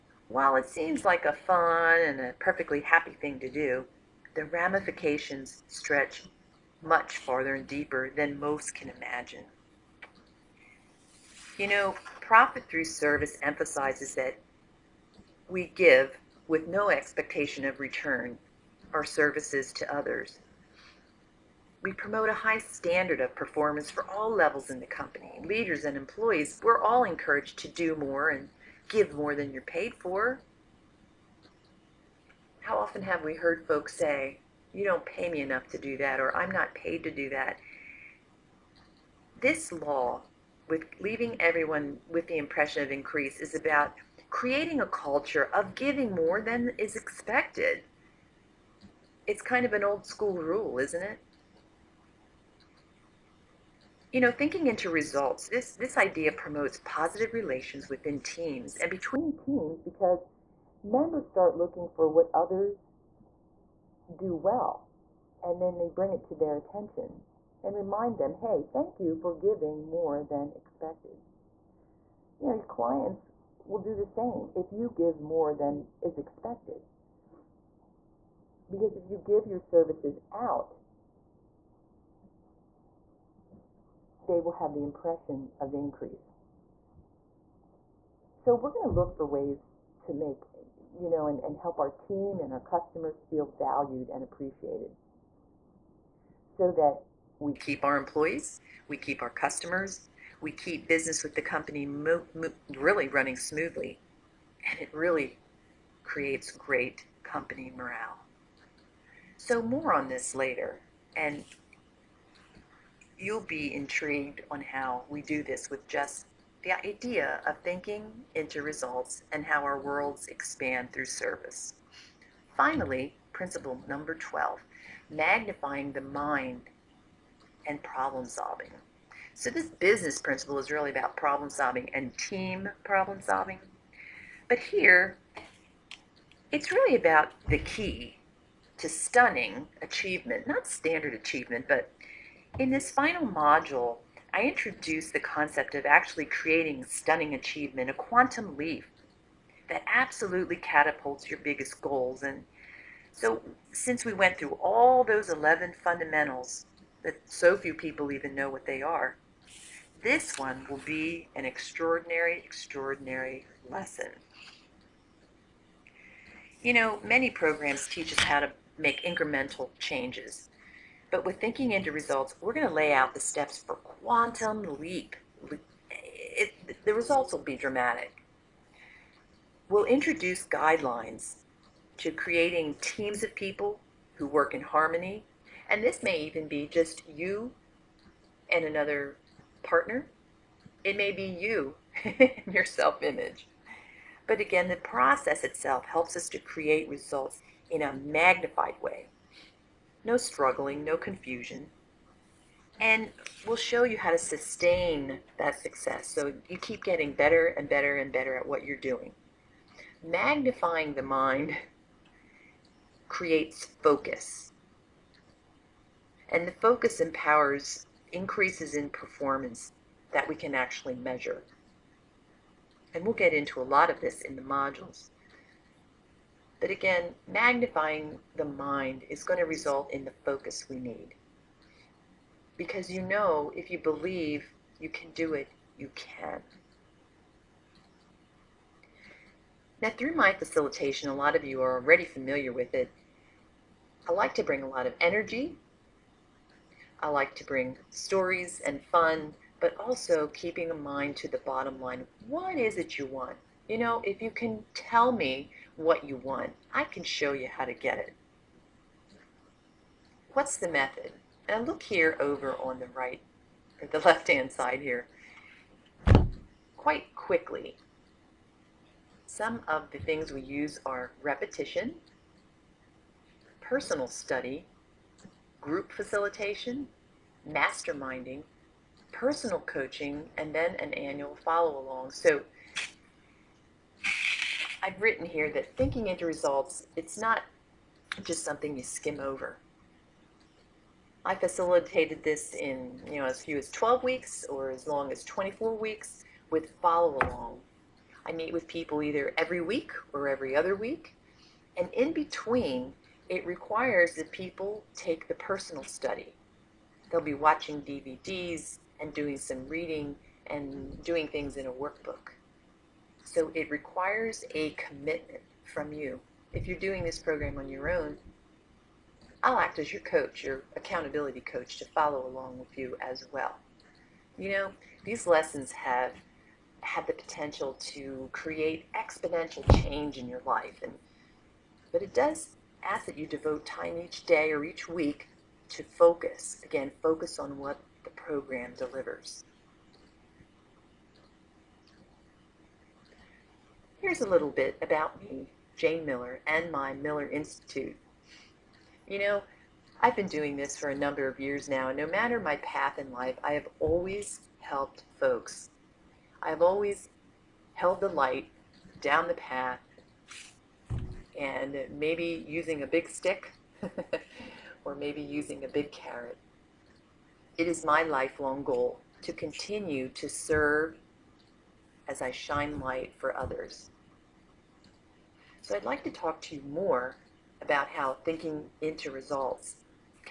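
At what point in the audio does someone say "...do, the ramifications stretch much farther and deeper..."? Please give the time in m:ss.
0:03.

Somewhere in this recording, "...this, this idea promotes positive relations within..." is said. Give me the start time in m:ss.
0:55.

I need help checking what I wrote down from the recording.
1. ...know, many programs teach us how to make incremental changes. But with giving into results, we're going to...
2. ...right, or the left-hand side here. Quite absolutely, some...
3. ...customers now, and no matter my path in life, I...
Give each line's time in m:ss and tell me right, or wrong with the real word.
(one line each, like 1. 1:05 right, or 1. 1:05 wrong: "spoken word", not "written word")
1. 2:46 wrong: "thinking", not "giving"
2. 4:22 wrong: "quickly", not "absolutely"
3. 5:51 wrong: "years", not "customers".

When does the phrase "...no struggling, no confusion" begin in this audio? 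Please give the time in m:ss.
3:20.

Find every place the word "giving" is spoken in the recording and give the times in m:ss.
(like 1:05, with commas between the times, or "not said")
0:45, 1:09.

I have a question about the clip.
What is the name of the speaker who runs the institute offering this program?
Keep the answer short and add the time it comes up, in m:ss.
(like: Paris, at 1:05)
Jane Miller, at 5:45.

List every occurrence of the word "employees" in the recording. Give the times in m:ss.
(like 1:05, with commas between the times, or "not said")
0:25, 1:37.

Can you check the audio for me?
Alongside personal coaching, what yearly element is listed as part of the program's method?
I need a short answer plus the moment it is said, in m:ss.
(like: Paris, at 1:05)
annual follow-along, at 4:40.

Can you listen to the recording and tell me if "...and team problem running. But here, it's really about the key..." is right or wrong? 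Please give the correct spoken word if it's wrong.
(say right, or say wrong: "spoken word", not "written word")
wrong: "solving", not "running".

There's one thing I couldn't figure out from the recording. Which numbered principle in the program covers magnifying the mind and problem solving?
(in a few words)
12.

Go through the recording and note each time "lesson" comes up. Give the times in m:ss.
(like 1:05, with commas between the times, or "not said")
2:43, 5:25.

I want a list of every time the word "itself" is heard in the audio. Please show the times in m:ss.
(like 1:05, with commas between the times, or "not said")
3:15.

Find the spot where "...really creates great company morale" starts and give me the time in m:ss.
1:44.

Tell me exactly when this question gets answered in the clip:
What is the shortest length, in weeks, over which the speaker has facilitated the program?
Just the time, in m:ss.
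4:53.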